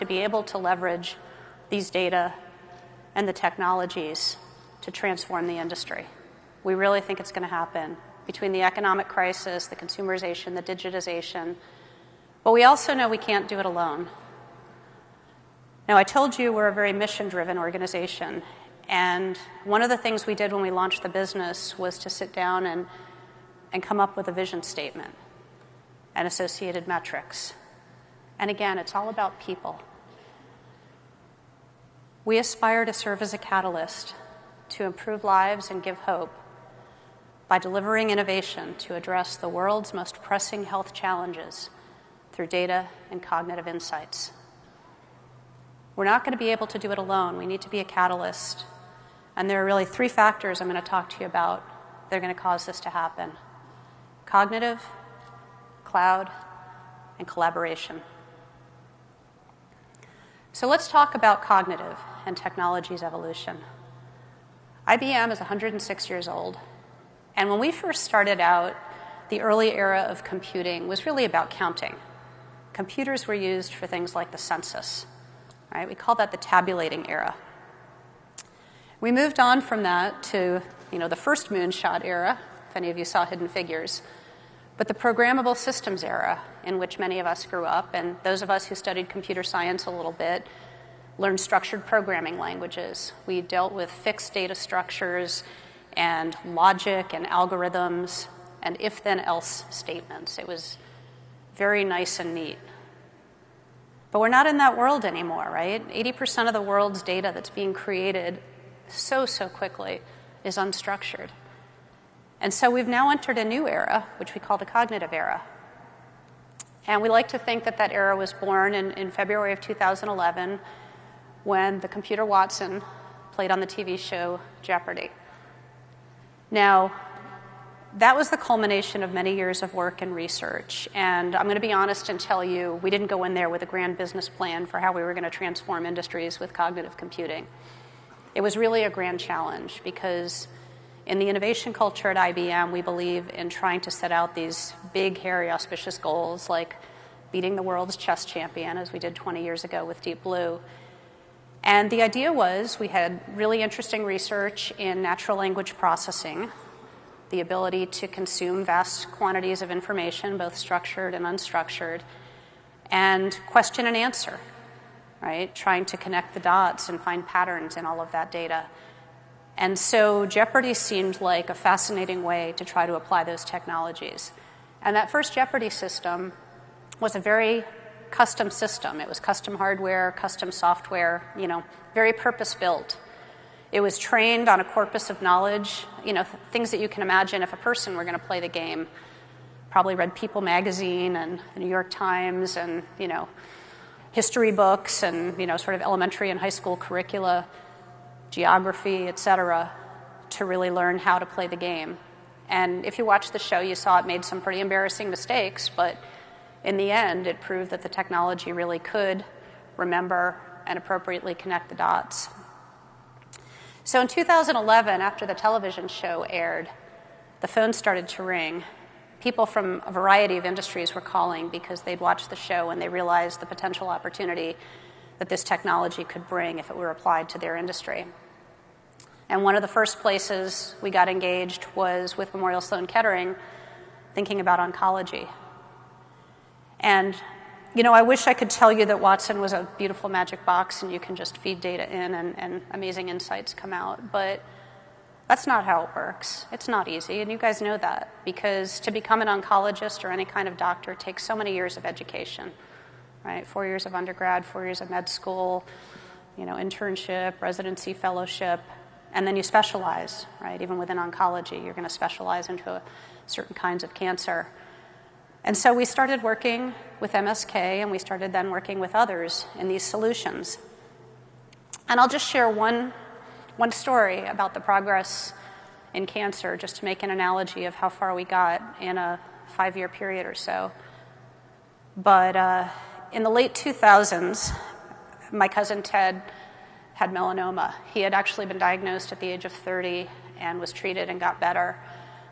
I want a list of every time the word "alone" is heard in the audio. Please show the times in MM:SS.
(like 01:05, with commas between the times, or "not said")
00:13, 00:46.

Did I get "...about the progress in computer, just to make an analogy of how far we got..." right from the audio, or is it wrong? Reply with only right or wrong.
wrong.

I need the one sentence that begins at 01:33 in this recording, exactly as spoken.
We dealt with fixed data structures and logic and algorithms and if then else statements.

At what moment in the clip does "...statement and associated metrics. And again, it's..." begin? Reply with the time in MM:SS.
00:24.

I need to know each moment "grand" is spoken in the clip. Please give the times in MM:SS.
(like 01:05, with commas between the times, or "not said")
02:13, 02:18.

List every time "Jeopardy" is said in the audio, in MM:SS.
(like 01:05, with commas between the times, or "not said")
02:04, 02:50, 02:55.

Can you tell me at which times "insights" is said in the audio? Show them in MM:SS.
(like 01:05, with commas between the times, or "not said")
00:43, 04:03.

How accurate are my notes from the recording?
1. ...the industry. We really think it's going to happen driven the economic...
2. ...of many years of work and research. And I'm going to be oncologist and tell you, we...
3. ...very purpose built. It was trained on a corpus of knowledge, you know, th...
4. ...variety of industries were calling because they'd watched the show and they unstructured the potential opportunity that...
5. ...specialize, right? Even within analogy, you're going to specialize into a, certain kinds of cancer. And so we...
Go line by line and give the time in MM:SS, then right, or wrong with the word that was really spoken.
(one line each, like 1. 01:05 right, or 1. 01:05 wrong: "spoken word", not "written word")
1. 00:05 wrong: "between", not "driven"
2. 02:09 wrong: "honest", not "oncologist"
3. 03:01 right
4. 03:39 wrong: "realized", not "unstructured"
5. 04:19 wrong: "oncology", not "analogy".